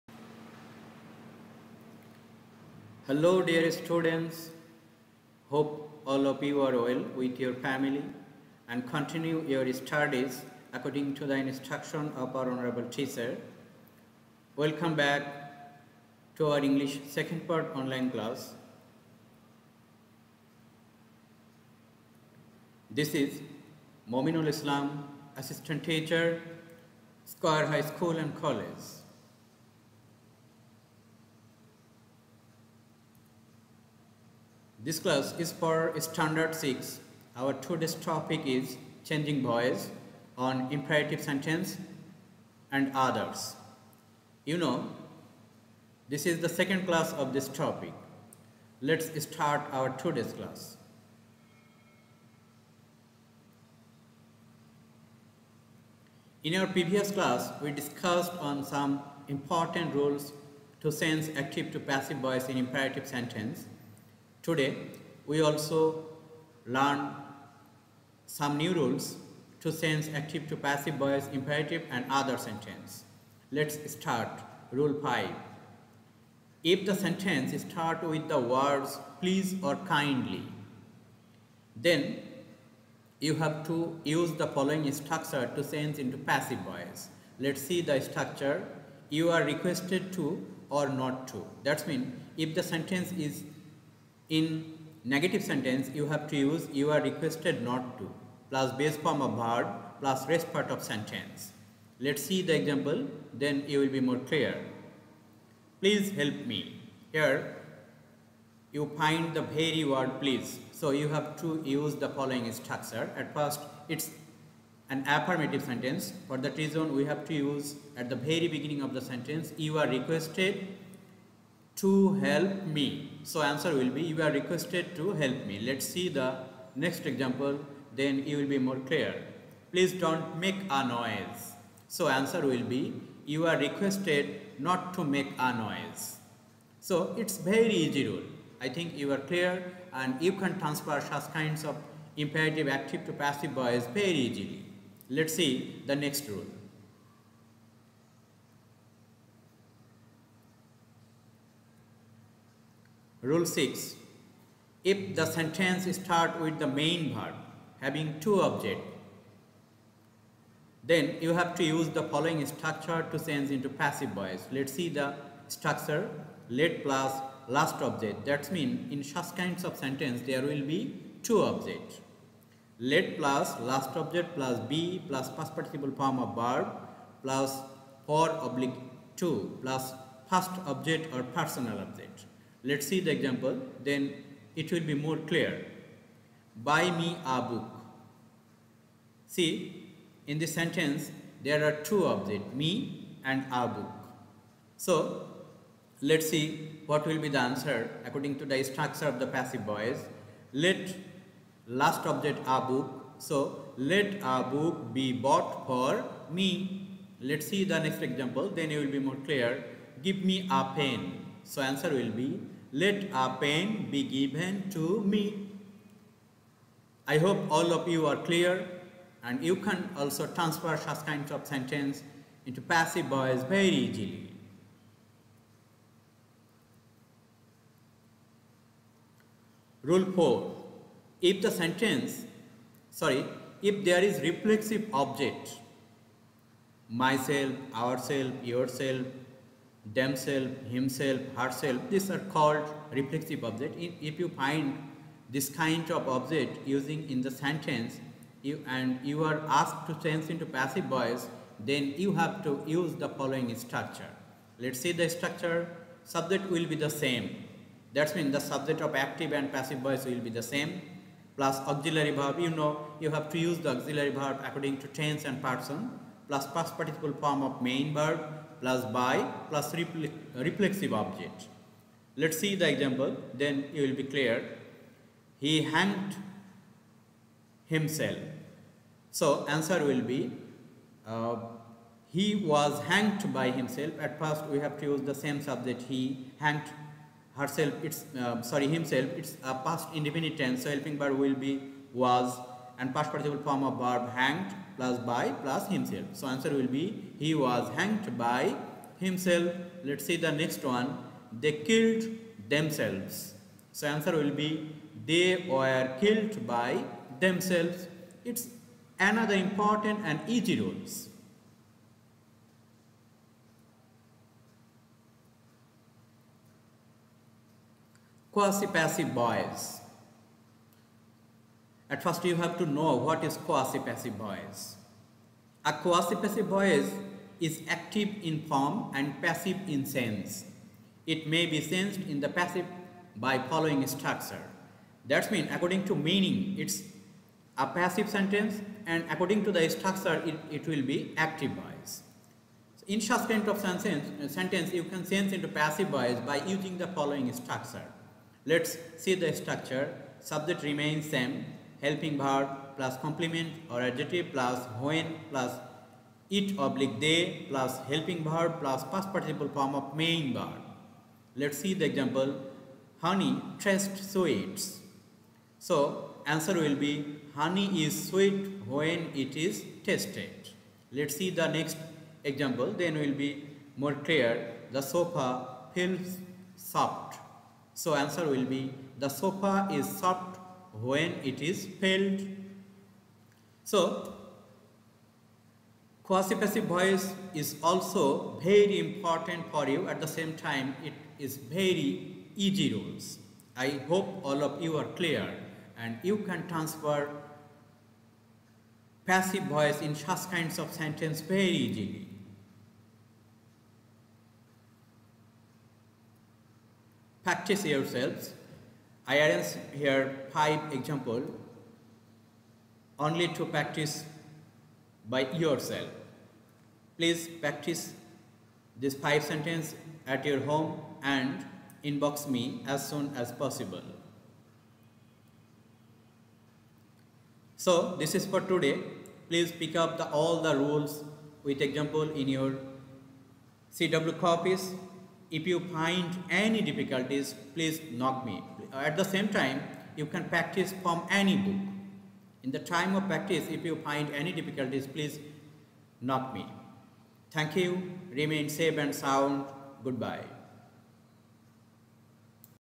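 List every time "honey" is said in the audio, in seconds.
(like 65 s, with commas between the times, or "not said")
363 s, 367 s.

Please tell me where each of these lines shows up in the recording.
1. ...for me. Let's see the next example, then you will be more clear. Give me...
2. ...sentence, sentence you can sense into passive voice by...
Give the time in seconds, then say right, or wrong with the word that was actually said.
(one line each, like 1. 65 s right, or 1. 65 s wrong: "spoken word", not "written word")
1. 205 s right
2. 343 s right.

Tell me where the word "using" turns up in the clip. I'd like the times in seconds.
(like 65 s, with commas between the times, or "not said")
246 s, 346 s.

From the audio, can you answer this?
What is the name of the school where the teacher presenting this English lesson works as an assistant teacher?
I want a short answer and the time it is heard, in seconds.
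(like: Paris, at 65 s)
Square High School and College, at 27 s.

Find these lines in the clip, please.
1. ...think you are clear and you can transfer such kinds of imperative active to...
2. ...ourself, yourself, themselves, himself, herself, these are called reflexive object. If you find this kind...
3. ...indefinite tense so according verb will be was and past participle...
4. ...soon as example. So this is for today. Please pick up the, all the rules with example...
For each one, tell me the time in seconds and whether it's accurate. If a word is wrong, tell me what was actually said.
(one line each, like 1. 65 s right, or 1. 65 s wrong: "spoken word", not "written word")
1. 138 s right
2. 237 s right
3. 289 s wrong: "helping", not "according"
4. 422 s wrong: "possible", not "example".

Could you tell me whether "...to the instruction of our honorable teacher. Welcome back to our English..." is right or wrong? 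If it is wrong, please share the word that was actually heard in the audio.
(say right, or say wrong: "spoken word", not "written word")
right.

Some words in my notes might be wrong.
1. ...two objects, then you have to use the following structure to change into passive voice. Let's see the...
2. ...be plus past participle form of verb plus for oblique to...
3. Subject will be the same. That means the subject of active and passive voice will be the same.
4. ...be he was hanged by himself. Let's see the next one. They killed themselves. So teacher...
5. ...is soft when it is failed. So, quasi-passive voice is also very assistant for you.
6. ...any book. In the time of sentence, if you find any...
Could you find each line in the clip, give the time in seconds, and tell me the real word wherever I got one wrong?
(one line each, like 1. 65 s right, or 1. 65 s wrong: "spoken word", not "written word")
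1. 158 s right
2. 174 s right
3. 256 s right
4. 296 s wrong: "answer", not "teacher"
5. 379 s wrong: "important", not "assistant"
6. 441 s wrong: "practice", not "sentence".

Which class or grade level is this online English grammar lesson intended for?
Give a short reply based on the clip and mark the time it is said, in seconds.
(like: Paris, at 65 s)
Standard 6, at 36 s.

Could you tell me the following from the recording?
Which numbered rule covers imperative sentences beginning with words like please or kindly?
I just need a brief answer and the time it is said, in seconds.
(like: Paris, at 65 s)
Rule 5, at 74 s.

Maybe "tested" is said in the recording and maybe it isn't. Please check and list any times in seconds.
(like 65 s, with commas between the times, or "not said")
369 s.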